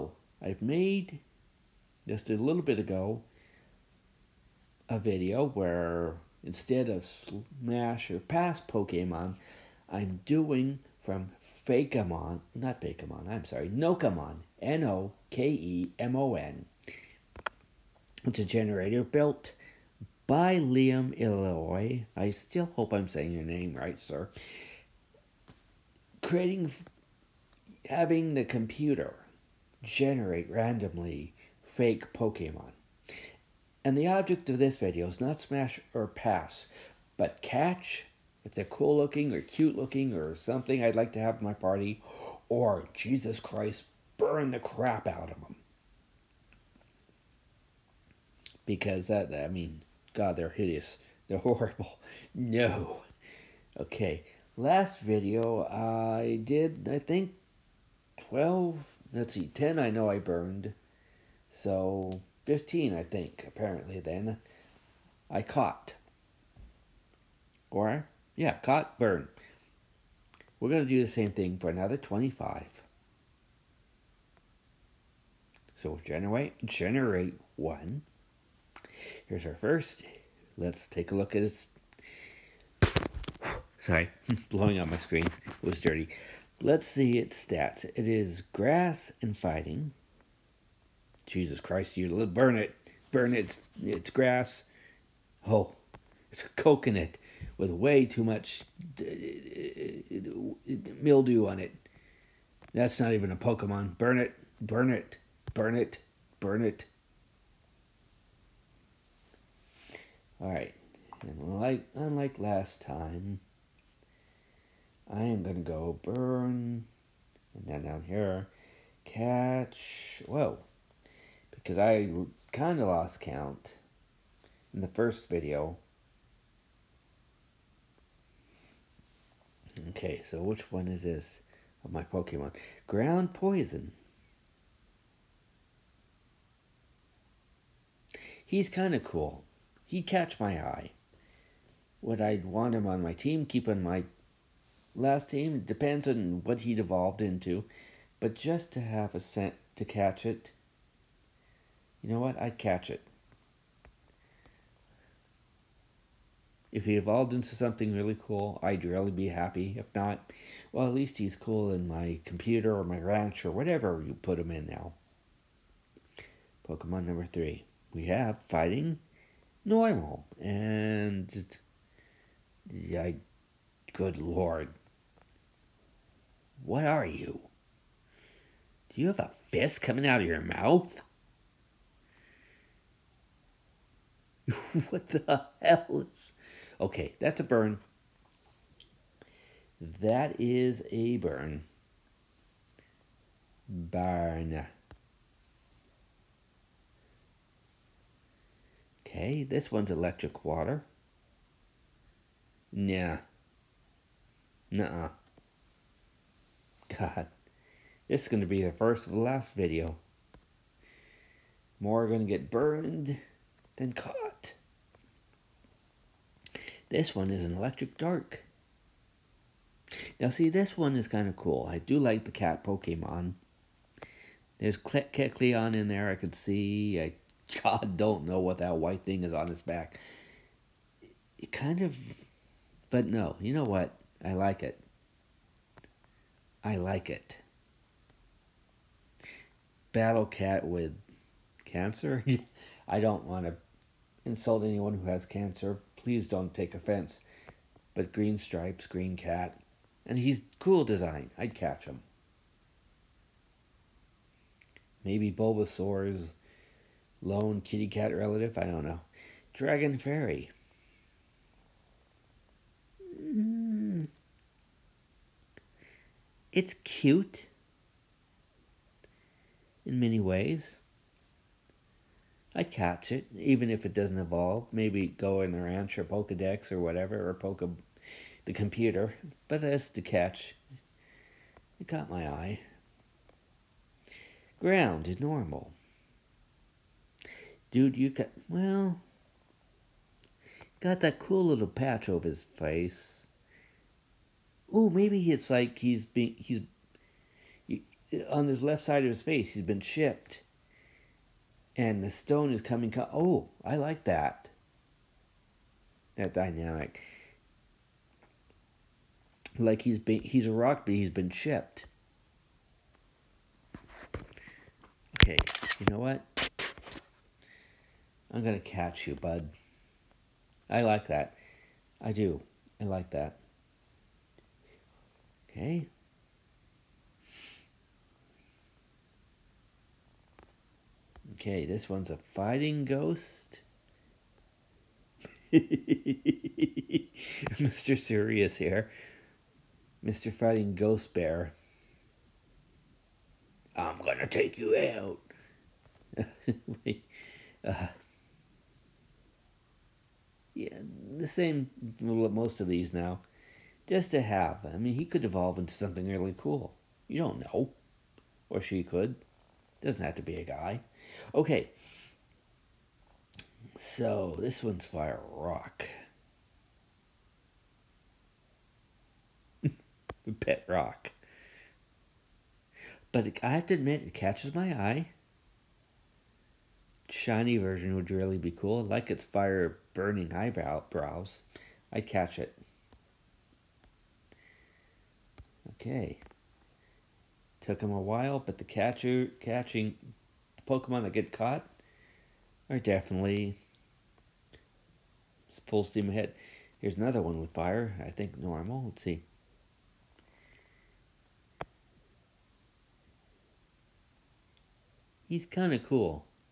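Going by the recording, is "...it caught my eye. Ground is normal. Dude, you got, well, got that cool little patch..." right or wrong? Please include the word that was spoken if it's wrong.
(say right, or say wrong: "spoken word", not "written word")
right.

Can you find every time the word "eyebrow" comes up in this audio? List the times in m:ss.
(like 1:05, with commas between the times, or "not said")
6:20.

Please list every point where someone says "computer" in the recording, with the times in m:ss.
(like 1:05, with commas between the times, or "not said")
0:28, 2:42, 4:38.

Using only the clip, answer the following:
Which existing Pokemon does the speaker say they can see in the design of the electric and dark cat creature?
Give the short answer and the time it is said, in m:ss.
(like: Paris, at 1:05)
Kecleon, at 3:45.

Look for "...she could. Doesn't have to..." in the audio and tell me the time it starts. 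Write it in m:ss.
5:58.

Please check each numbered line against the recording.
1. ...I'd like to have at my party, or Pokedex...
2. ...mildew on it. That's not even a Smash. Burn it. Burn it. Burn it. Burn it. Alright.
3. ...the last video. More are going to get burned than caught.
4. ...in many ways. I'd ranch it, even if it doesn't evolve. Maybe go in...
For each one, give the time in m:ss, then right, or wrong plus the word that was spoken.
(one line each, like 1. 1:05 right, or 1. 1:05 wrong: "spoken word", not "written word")
1. 0:40 wrong: "Jesus", not "Pokedex"
2. 1:41 wrong: "Pokemon", not "Smash"
3. 3:29 right
4. 4:29 wrong: "catch", not "ranch".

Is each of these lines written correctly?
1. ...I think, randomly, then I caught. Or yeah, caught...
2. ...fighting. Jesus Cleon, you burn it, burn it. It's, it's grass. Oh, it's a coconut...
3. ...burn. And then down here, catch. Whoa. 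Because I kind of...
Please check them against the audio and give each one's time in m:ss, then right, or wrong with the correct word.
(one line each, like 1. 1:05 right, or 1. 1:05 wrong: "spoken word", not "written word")
1. 1:02 wrong: "apparently", not "randomly"
2. 1:29 wrong: "Christ", not "Cleon"
3. 1:56 right.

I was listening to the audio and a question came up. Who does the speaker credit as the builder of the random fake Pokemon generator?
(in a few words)
Liam Illinois.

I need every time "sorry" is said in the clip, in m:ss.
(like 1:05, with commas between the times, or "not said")
0:13, 1:23.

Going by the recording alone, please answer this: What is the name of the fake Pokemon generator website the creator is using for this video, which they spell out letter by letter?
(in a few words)
Nokemon.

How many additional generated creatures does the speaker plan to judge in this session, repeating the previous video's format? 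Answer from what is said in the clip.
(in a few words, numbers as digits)
25.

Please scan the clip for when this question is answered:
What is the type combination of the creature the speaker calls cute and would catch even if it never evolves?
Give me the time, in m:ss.
4:19.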